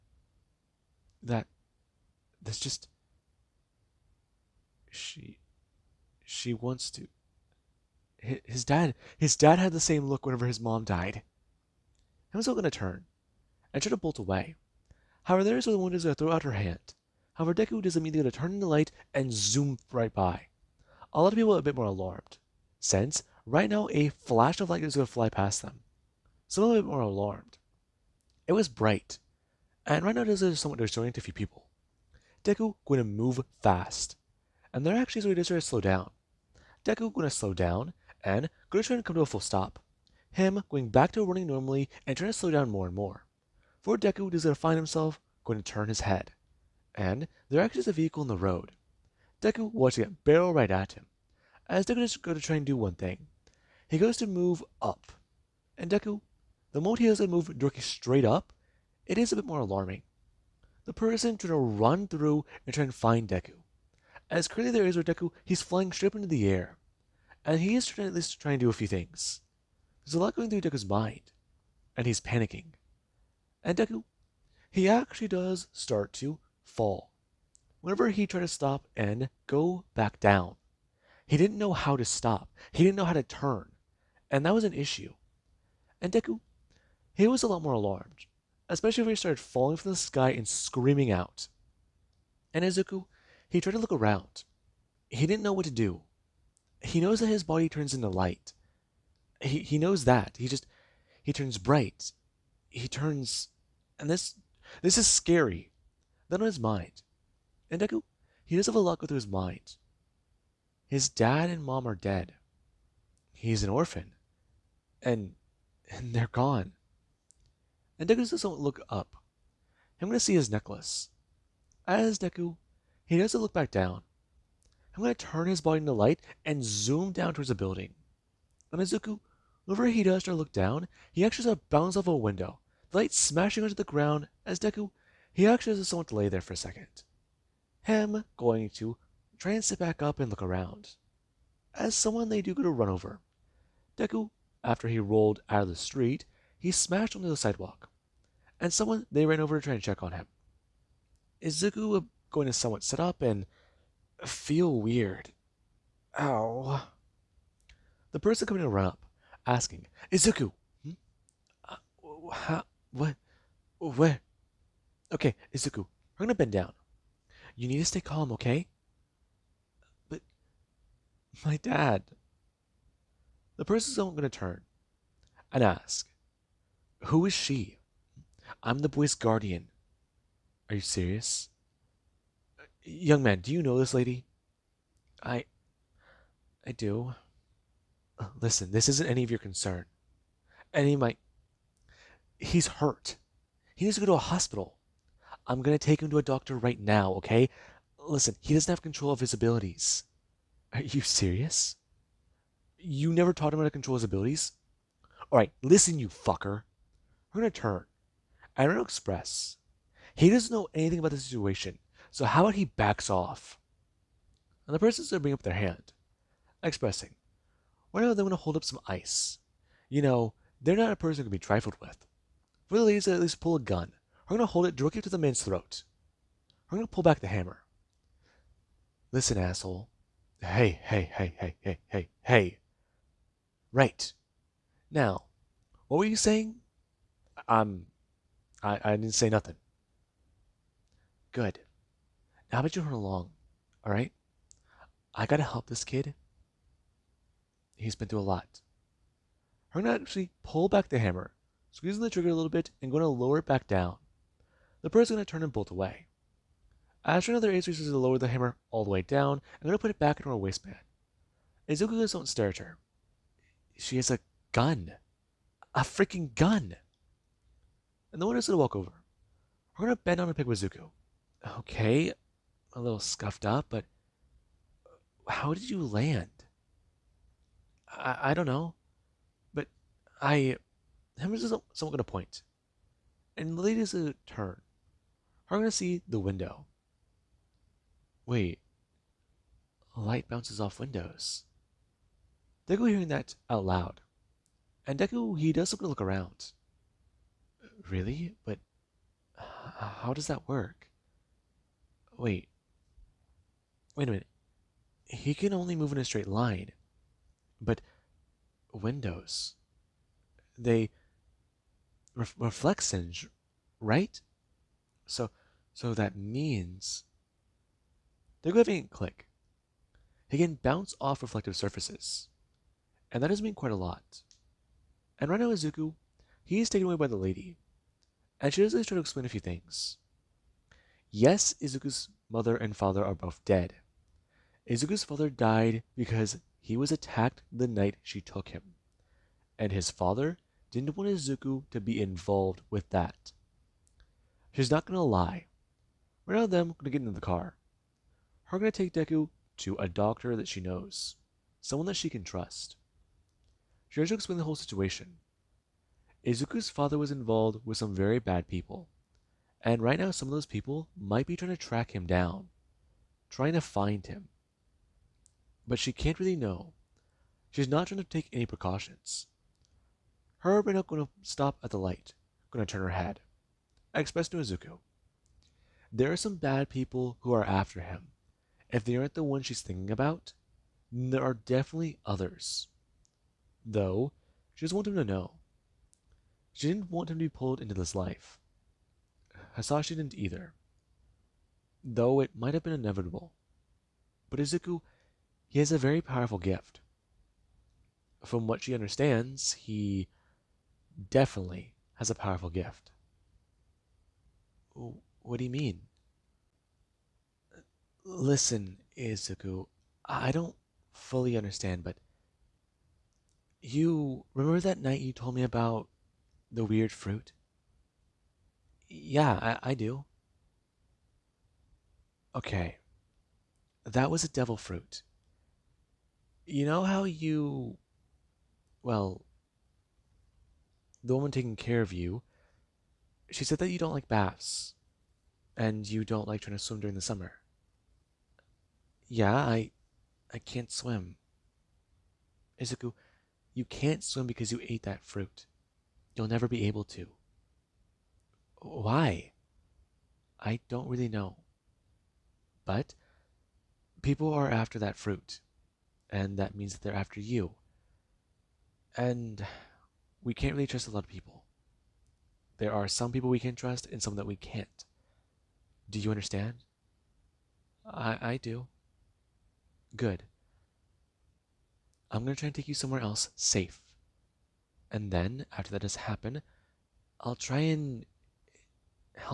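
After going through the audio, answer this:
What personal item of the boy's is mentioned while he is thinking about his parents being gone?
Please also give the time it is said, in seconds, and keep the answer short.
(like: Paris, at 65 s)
Necklace, at 120 s.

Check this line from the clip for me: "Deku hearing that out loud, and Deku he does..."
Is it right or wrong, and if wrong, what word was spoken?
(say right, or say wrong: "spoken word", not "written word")
right.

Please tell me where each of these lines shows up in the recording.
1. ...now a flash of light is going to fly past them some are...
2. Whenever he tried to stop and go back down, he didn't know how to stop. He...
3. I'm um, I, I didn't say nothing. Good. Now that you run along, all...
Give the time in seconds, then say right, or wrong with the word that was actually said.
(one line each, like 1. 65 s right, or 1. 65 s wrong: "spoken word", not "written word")
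1. 23 s right
2. 77 s right
3. 237 s right.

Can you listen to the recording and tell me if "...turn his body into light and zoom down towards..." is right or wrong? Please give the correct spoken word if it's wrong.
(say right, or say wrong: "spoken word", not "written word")
right.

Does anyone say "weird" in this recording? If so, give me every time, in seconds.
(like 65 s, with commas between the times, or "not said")
154 s, 416 s.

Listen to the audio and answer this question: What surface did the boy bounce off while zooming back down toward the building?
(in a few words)
A window.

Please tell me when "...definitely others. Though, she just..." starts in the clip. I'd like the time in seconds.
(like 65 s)
381 s.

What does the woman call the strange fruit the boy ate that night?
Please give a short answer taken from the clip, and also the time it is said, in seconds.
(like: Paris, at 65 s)
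Devil fruit, at 424 s.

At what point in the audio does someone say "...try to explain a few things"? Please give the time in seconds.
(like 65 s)
328 s.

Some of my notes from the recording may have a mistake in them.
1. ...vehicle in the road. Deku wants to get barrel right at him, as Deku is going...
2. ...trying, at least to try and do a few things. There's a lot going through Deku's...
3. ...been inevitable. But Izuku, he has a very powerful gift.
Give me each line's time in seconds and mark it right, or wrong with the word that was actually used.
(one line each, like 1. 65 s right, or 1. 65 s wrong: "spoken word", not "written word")
1. 47 s right
2. 67 s right
3. 392 s right.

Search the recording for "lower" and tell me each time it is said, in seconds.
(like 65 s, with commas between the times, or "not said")
253 s, 257 s.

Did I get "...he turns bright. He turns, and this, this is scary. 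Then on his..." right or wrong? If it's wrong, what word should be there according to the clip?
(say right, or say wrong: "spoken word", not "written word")
right.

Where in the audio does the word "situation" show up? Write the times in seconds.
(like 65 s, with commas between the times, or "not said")
211 s, 354 s.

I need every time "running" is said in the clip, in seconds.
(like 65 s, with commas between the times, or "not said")
41 s.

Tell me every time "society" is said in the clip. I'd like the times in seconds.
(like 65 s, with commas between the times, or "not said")
not said.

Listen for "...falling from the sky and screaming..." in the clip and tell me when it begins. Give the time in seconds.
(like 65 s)
89 s.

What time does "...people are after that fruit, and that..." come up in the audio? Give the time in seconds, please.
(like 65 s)
454 s.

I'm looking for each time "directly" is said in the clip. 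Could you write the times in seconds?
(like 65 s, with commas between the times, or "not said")
57 s, 224 s.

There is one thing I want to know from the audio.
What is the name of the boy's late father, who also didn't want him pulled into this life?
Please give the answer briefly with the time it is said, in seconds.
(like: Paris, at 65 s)
Hisashi, at 389 s.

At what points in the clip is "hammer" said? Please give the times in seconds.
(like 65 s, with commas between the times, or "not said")
227 s, 250 s, 258 s.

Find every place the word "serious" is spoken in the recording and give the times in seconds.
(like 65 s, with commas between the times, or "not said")
180 s, 201 s.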